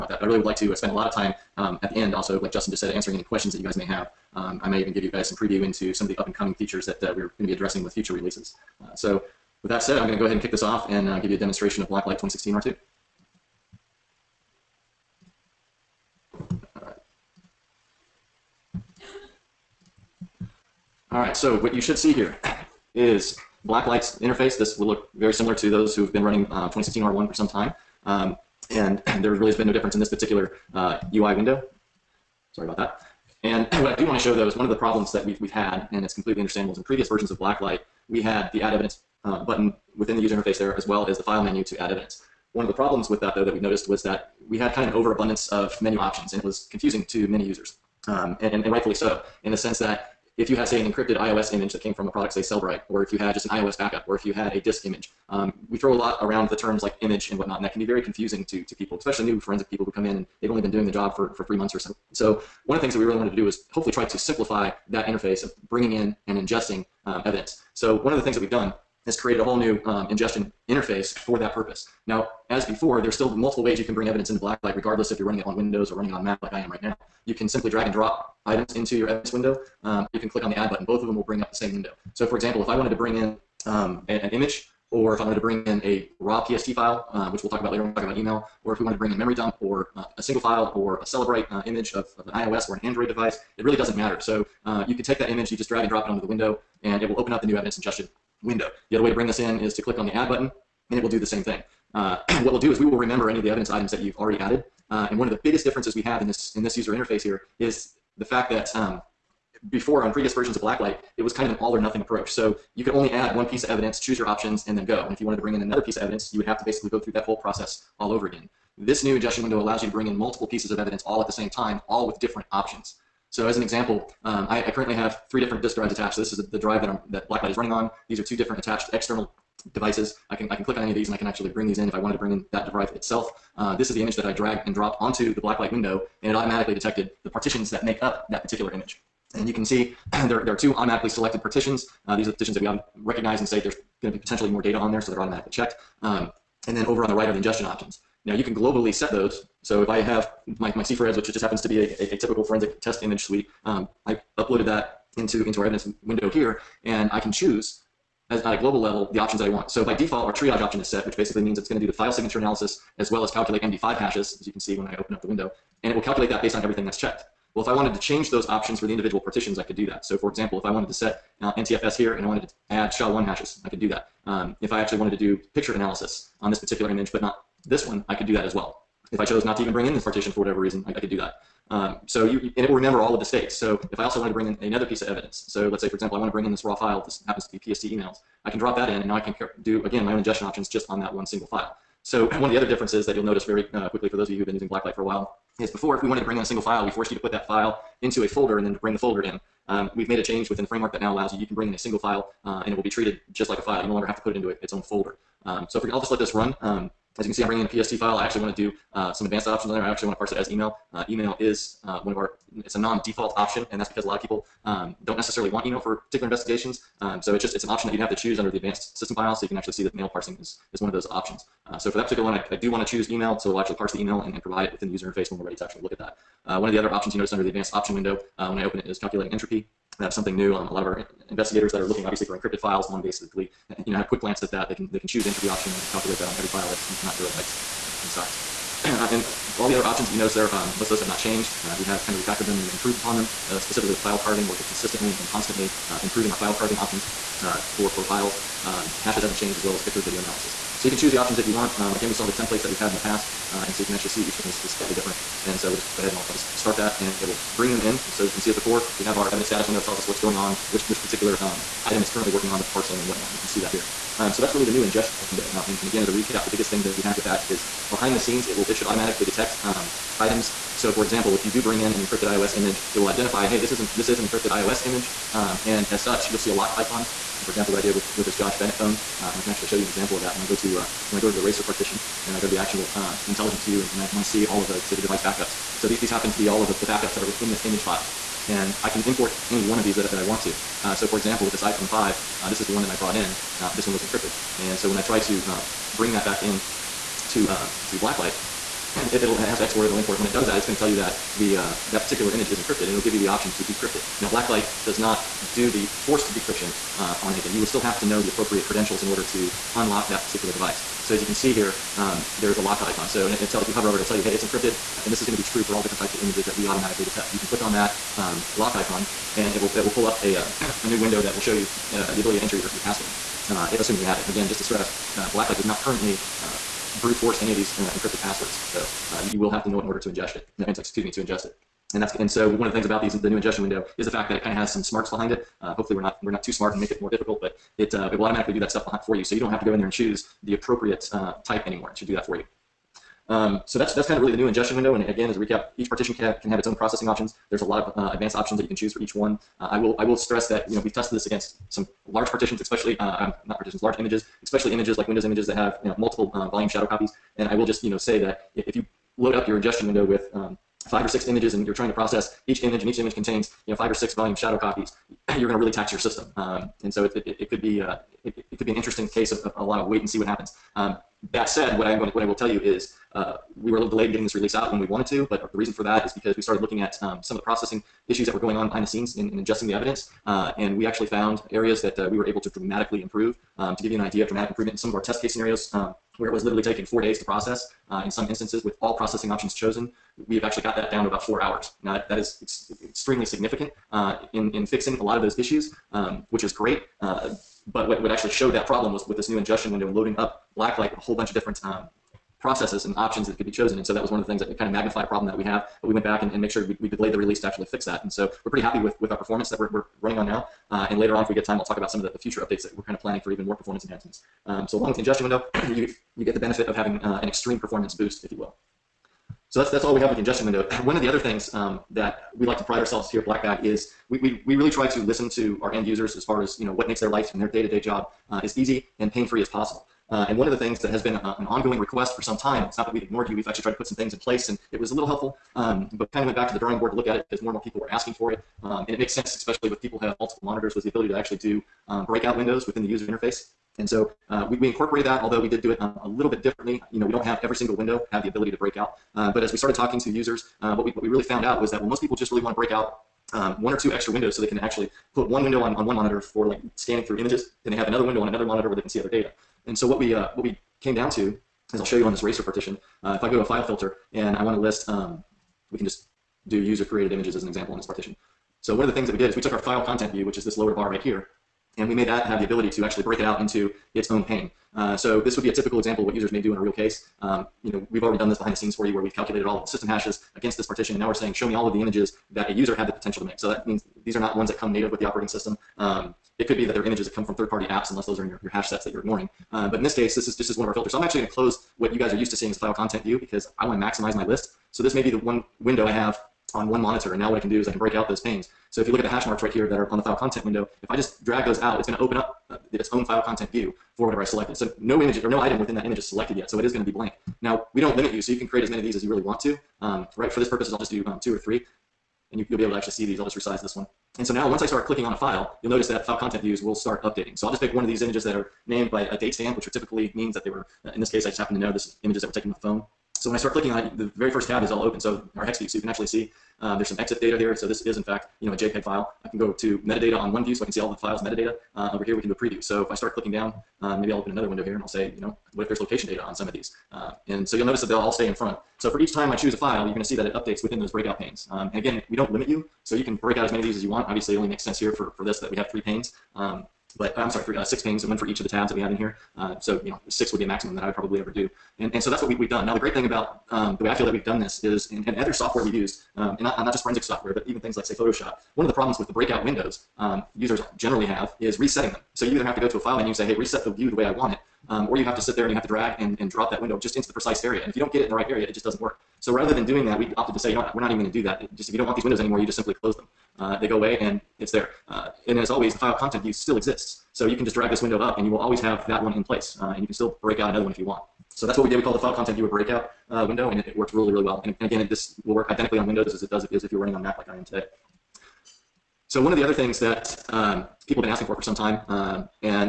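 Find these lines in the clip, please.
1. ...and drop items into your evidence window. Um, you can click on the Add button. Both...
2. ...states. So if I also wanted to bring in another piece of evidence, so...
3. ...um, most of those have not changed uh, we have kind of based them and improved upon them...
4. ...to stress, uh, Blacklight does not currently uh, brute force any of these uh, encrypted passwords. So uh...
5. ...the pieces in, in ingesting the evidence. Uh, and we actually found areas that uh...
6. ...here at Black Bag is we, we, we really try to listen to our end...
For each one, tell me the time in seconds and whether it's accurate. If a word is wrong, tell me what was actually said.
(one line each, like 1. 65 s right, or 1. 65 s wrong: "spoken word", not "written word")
1. 77 s right
2. 183 s right
3. 240 s wrong: "refactored", not "based"
4. 324 s right
5. 378 s wrong: "scenes", not "pieces"
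6. 423 s right.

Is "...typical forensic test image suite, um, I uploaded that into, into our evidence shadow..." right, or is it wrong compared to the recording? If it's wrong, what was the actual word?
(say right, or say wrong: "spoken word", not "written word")
wrong: "window", not "shadow".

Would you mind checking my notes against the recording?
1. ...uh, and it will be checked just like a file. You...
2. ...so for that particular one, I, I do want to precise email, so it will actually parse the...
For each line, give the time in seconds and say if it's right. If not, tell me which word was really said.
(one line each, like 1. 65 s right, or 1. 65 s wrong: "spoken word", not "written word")
1. 202 s wrong: "treated", not "checked"
2. 221 s wrong: "choose", not "precise".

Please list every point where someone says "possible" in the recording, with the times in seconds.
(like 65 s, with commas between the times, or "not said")
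429 s.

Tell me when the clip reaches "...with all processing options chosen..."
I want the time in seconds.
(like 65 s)
388 s.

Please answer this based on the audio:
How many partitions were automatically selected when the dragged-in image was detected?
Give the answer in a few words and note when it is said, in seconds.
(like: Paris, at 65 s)
2, at 140 s.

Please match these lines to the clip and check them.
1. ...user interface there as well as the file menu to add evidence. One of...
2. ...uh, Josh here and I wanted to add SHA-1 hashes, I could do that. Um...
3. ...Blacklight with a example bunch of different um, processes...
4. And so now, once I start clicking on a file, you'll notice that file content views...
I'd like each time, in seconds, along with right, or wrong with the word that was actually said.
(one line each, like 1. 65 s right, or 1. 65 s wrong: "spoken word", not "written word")
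1. 40 s right
2. 171 s wrong: "NTFS", not "Josh"
3. 400 s wrong: "whole", not "example"
4. 514 s right.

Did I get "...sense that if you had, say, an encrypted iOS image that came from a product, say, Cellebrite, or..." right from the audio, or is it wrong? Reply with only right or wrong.
right.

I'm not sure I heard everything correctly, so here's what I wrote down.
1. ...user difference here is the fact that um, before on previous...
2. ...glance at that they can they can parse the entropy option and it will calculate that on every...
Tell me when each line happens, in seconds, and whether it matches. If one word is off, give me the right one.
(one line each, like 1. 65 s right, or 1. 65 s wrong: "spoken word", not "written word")
1. 106 s wrong: "interface", not "difference"
2. 234 s wrong: "choose", not "parse".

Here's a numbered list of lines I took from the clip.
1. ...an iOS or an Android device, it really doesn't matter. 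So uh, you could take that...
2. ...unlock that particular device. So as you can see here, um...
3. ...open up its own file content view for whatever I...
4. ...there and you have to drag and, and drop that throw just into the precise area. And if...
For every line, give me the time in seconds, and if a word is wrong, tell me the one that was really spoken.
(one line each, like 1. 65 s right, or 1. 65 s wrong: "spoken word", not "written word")
1. 92 s right
2. 309 s right
3. 501 s right
4. 565 s wrong: "window", not "throw".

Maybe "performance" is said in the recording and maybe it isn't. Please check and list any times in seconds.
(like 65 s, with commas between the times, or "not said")
409 s, 413 s, 417 s.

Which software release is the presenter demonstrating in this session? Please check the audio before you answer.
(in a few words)
Blacklight 2016 R2.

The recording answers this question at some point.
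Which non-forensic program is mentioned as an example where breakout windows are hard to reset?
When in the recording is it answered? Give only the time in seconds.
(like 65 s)
557 s.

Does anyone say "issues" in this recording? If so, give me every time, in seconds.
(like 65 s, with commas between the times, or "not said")
378 s, 395 s.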